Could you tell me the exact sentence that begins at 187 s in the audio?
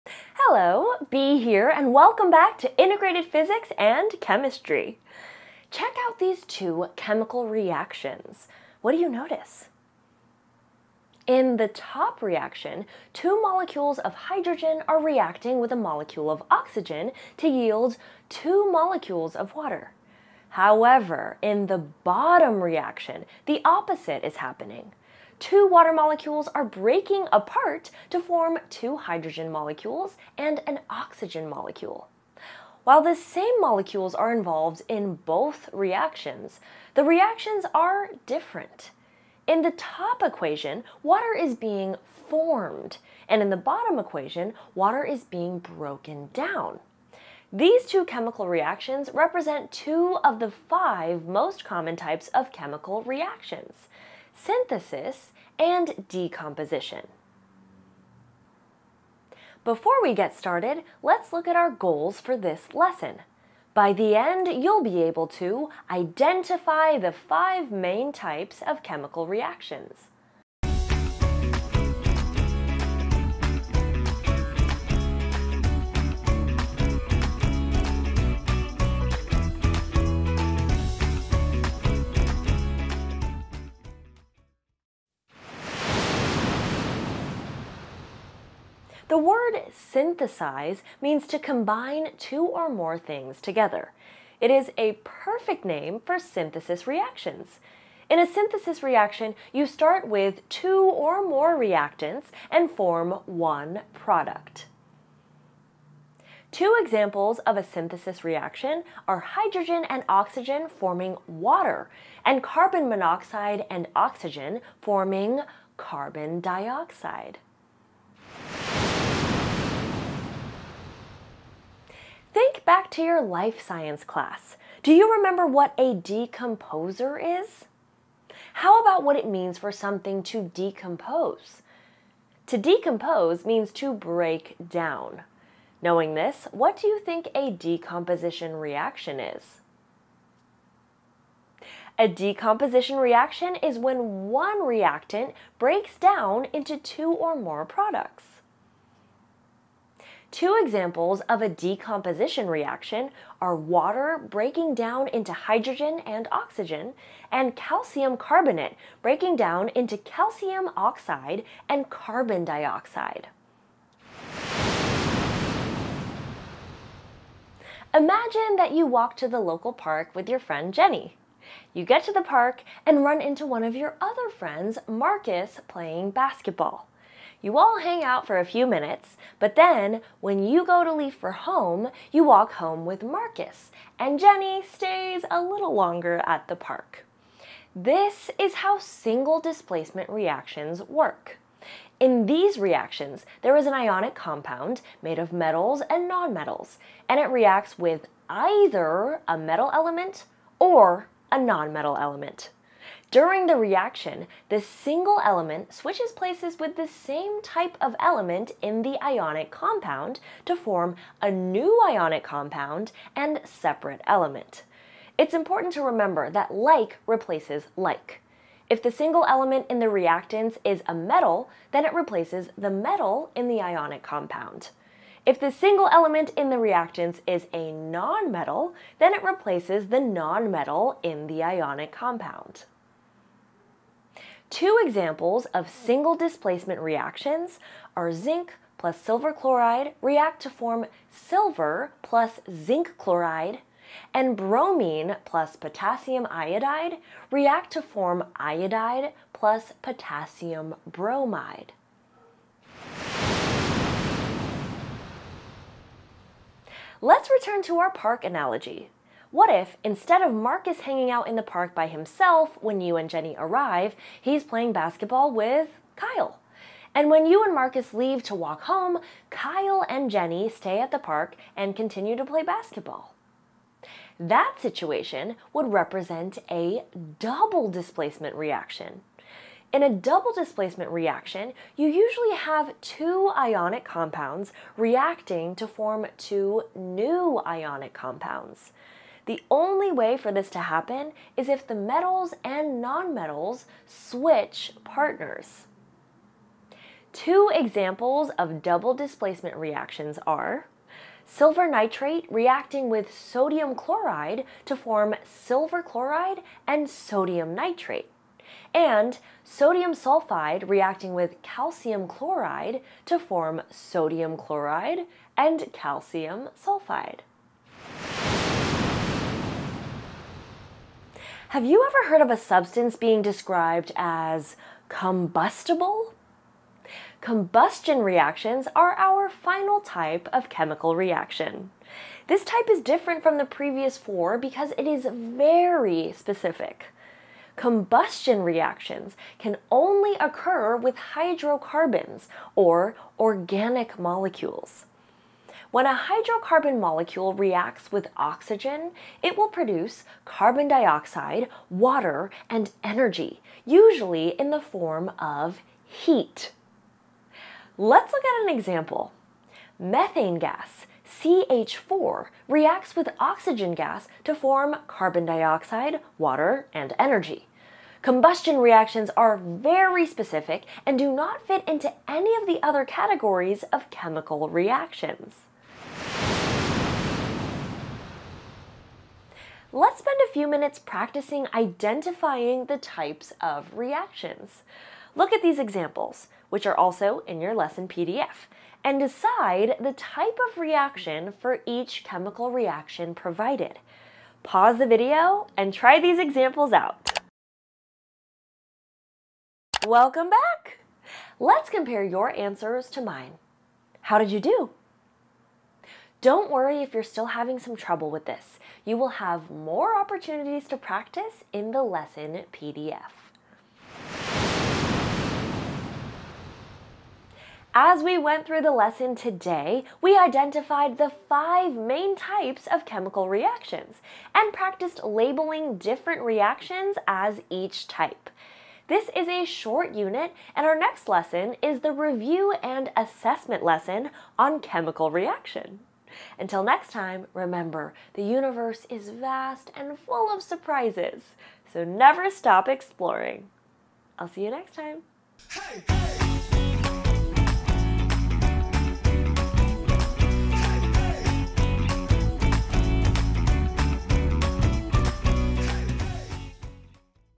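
This is how single displacement reactions work.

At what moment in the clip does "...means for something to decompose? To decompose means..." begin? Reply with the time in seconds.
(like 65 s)
129 s.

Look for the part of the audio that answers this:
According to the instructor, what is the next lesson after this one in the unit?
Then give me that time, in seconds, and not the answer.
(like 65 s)
431 s.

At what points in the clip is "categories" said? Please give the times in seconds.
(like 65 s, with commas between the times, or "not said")
372 s.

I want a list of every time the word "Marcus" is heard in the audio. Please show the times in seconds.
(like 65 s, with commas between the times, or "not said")
174 s, 183 s, 260 s, 267 s.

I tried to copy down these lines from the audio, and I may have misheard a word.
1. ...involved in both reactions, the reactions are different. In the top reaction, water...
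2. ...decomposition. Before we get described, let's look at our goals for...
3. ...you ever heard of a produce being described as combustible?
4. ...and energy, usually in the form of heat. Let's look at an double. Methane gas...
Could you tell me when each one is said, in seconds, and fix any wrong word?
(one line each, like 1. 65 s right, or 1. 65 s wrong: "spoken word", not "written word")
1. 34 s wrong: "equation", not "reaction"
2. 56 s wrong: "started", not "described"
3. 321 s wrong: "substance", not "produce"
4. 352 s wrong: "example", not "double".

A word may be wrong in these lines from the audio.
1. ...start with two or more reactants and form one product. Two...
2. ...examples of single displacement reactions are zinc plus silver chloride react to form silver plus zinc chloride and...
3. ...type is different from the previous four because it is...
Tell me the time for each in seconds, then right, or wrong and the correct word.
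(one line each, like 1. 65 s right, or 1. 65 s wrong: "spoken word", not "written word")
1. 99 s right
2. 234 s right
3. 332 s right.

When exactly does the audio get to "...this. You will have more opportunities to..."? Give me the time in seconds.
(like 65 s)
408 s.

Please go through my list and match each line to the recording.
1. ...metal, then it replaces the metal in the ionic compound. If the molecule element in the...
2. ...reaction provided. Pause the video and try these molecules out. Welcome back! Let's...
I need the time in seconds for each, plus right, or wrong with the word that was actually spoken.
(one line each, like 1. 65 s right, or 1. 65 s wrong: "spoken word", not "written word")
1. 220 s wrong: "single", not "molecule"
2. 392 s wrong: "examples", not "molecules".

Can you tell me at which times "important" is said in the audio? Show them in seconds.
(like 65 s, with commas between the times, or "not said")
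215 s.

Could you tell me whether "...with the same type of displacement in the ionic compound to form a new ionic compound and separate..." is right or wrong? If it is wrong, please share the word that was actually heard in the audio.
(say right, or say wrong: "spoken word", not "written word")
wrong: "element", not "displacement".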